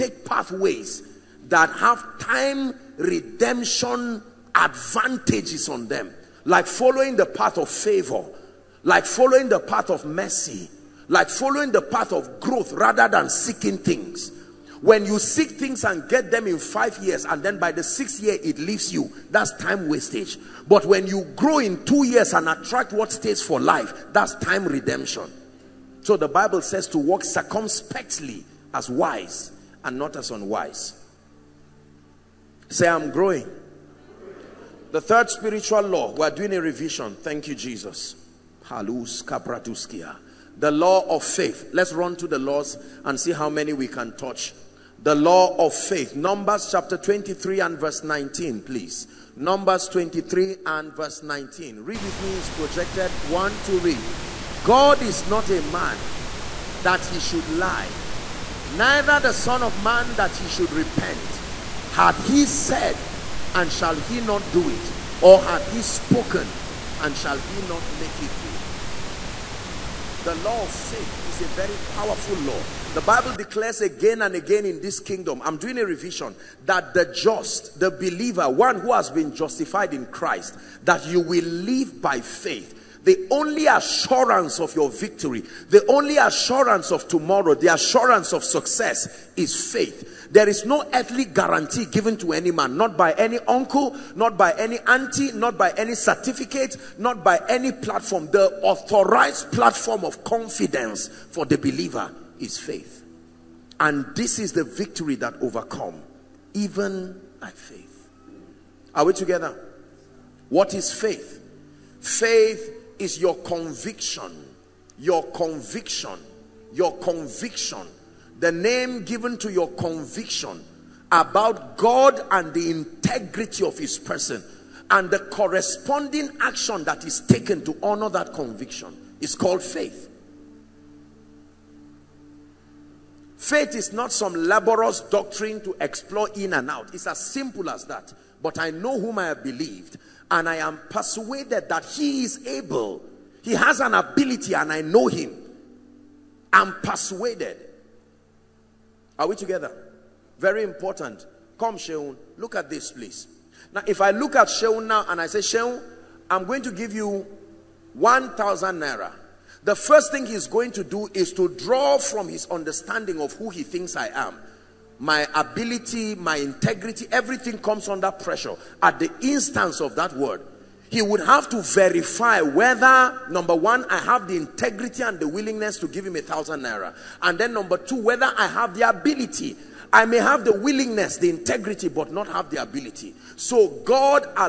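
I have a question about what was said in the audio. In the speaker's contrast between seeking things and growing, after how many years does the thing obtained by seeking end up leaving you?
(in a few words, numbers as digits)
6th year.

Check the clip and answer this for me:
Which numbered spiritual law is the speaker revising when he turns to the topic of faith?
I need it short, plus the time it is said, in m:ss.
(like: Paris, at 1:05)
3rd, at 0:34.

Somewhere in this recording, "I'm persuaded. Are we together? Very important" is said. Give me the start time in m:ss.
2:26.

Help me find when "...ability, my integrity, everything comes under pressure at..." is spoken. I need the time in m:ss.
2:45.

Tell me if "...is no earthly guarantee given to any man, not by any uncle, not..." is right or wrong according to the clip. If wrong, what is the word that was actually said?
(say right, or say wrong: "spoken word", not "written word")
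right.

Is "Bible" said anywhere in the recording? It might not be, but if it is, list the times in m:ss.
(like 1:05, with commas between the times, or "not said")
0:26, 1:13.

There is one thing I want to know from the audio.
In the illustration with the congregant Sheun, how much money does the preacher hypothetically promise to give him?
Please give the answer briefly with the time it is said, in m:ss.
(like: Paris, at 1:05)
1,000 naira, at 2:37.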